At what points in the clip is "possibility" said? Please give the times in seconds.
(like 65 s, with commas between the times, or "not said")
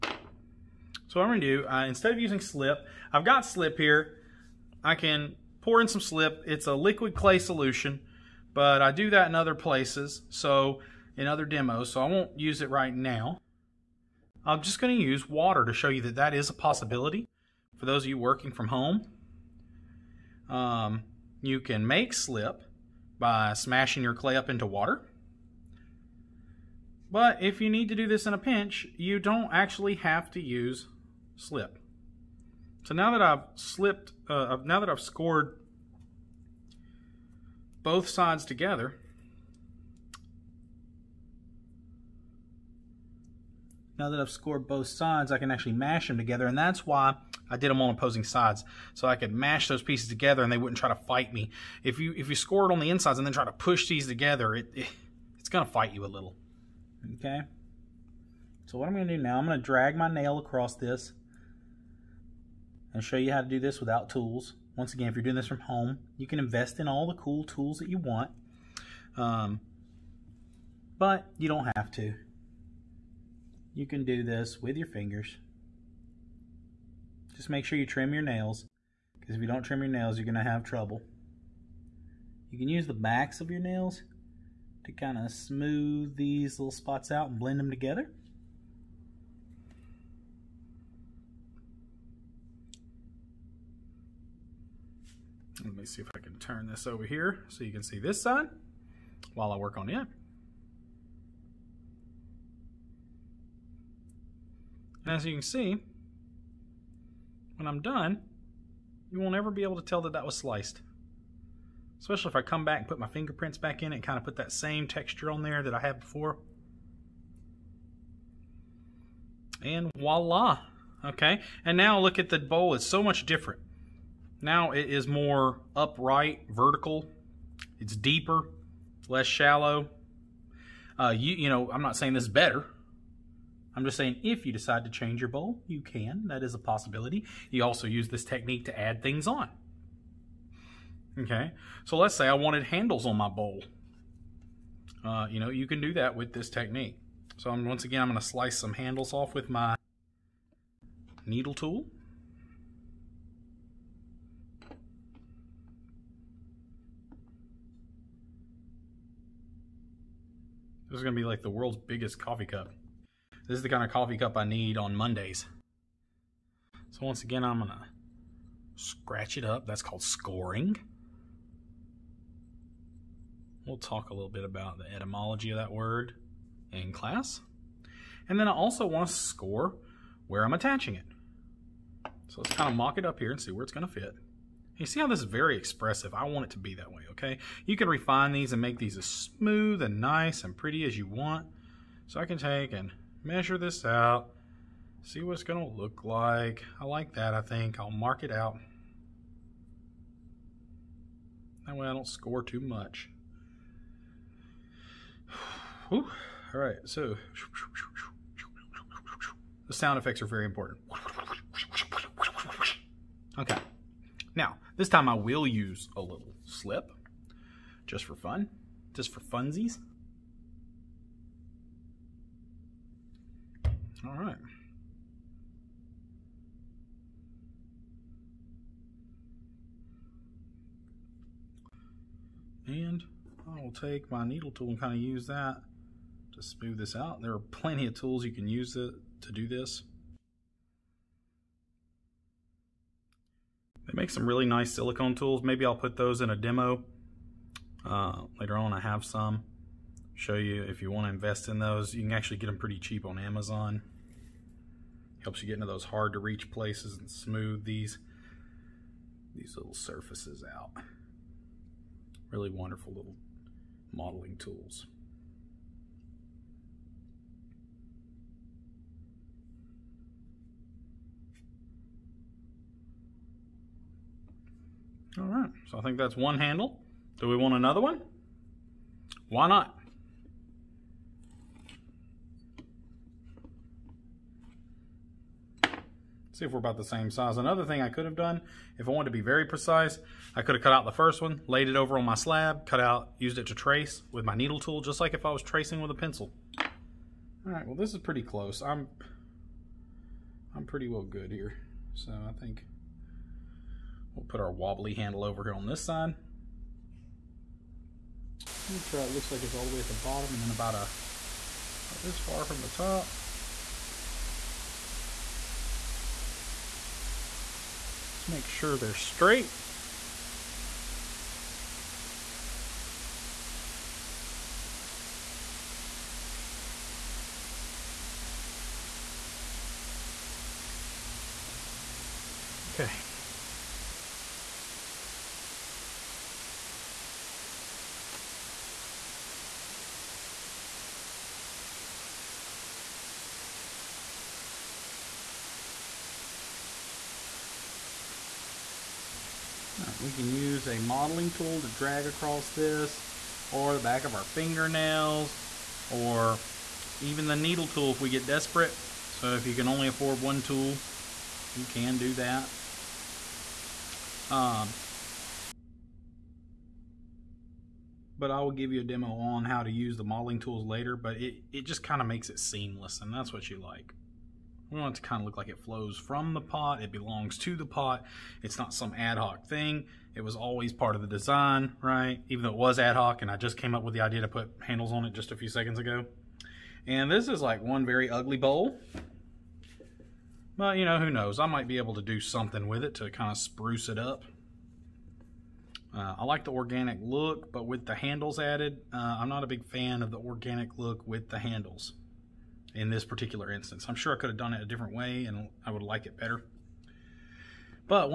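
16 s, 136 s.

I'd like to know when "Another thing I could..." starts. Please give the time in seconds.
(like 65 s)
287 s.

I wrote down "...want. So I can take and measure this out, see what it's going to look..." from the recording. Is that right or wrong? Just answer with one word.
right.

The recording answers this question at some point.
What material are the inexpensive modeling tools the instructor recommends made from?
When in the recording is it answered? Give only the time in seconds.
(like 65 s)
244 s.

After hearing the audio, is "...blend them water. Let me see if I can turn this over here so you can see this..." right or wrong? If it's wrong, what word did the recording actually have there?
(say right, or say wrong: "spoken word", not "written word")
wrong: "together", not "water".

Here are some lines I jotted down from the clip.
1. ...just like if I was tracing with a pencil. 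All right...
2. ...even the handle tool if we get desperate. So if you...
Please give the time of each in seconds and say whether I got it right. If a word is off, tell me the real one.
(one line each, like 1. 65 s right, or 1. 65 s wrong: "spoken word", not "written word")
1. 294 s right
2. 357 s wrong: "needle", not "handle".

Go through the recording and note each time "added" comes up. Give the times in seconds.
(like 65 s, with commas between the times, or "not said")
398 s.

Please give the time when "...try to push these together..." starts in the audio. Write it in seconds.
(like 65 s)
53 s.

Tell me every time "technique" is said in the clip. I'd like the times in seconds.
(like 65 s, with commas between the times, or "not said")
138 s, 146 s.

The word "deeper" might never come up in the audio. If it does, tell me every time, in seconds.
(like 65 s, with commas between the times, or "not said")
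127 s.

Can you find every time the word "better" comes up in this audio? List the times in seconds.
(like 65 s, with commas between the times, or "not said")
132 s, 406 s.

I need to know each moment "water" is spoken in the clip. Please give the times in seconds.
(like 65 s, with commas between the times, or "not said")
15 s, 24 s.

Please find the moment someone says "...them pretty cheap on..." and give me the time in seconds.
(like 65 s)
252 s.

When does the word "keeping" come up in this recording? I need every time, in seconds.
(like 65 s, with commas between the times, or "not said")
not said.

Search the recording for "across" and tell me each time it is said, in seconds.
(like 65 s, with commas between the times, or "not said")
60 s, 352 s.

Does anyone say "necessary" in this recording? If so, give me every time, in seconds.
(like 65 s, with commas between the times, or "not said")
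not said.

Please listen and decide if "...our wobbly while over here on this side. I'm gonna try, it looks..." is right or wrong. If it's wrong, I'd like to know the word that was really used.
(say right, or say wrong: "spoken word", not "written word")
wrong: "handle", not "while".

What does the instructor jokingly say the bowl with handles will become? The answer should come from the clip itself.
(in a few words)
The world's biggest coffee cup.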